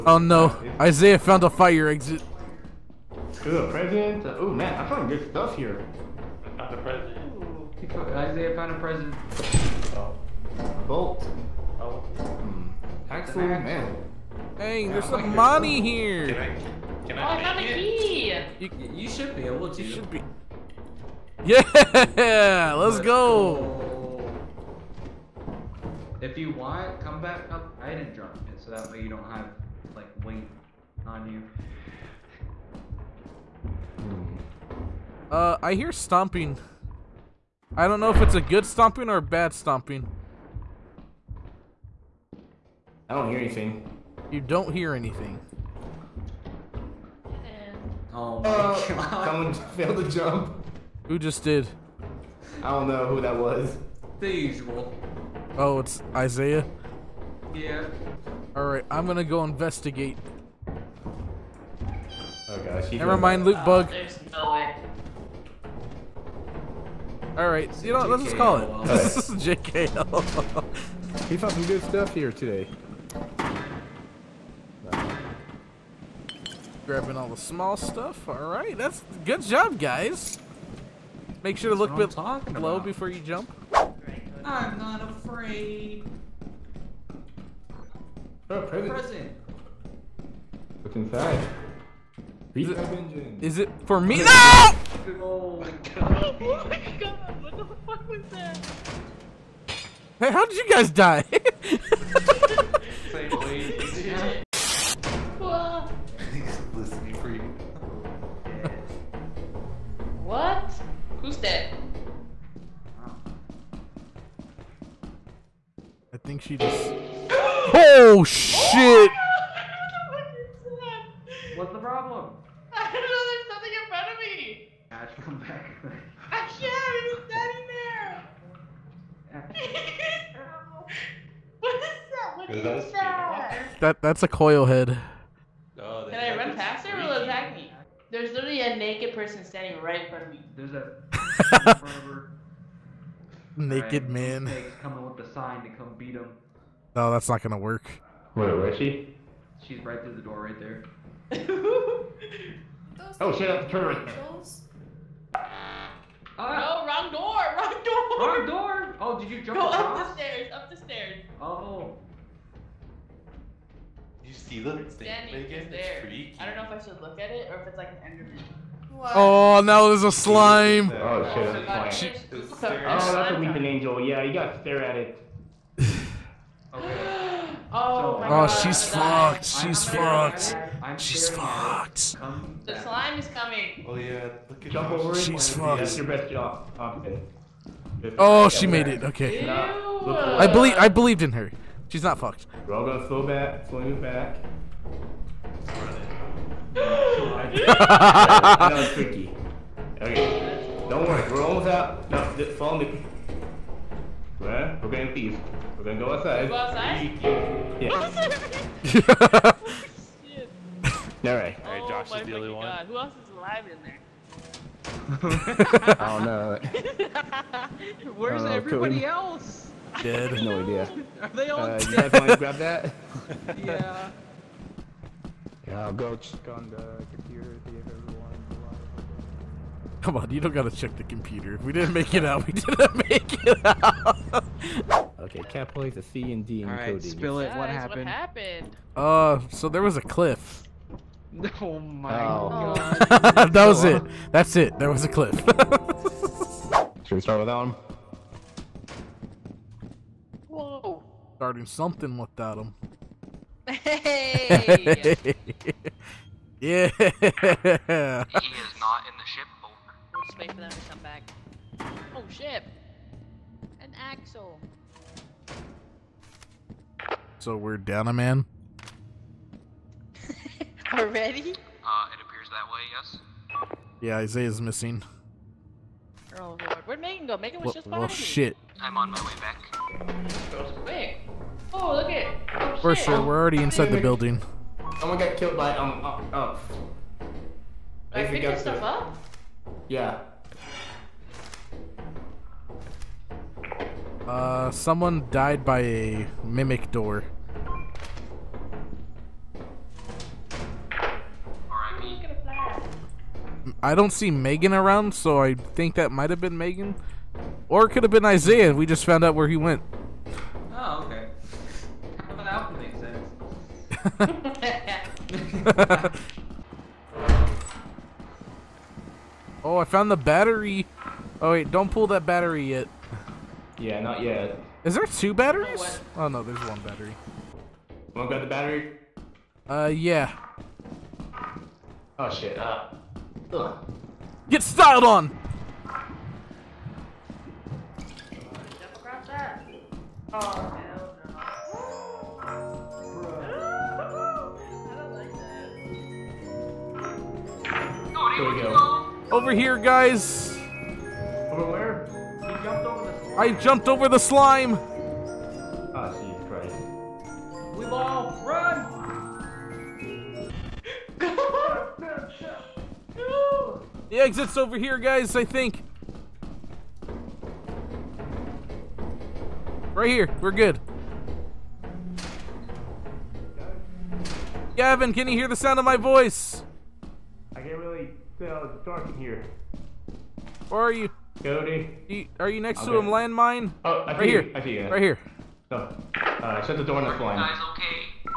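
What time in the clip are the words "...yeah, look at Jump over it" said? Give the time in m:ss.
3:03.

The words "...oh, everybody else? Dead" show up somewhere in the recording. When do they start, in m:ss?
3:38.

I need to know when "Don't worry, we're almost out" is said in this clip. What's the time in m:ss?
3:20.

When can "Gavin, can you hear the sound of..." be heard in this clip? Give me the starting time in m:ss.
6:14.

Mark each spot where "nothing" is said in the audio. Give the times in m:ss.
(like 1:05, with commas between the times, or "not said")
2:03.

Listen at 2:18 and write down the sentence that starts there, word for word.
There's literally a naked person standing right in front of me.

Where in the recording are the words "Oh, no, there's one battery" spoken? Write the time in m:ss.
5:26.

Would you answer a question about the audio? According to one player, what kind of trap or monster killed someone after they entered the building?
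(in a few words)
mimic door.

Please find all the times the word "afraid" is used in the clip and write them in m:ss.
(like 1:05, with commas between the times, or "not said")
1:25.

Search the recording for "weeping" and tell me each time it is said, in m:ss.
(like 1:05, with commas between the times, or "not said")
2:53.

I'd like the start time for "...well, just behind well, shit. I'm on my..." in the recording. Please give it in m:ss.
4:37.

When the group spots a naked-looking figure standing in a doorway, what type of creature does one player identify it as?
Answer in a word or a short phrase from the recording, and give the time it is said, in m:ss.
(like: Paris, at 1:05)
coil head, at 2:14.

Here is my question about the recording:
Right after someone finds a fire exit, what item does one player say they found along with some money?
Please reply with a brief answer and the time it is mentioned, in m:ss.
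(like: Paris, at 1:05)
a key, at 0:17.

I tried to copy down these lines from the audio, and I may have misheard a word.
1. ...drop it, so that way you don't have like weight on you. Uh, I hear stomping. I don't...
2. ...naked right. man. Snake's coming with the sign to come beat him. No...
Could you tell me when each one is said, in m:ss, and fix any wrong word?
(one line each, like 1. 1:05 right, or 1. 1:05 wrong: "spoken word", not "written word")
1. 0:28 right
2. 2:23 right.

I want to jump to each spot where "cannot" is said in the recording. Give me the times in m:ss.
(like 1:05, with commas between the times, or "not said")
not said.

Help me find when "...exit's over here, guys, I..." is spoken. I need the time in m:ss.
6:04.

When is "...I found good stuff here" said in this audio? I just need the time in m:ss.
0:04.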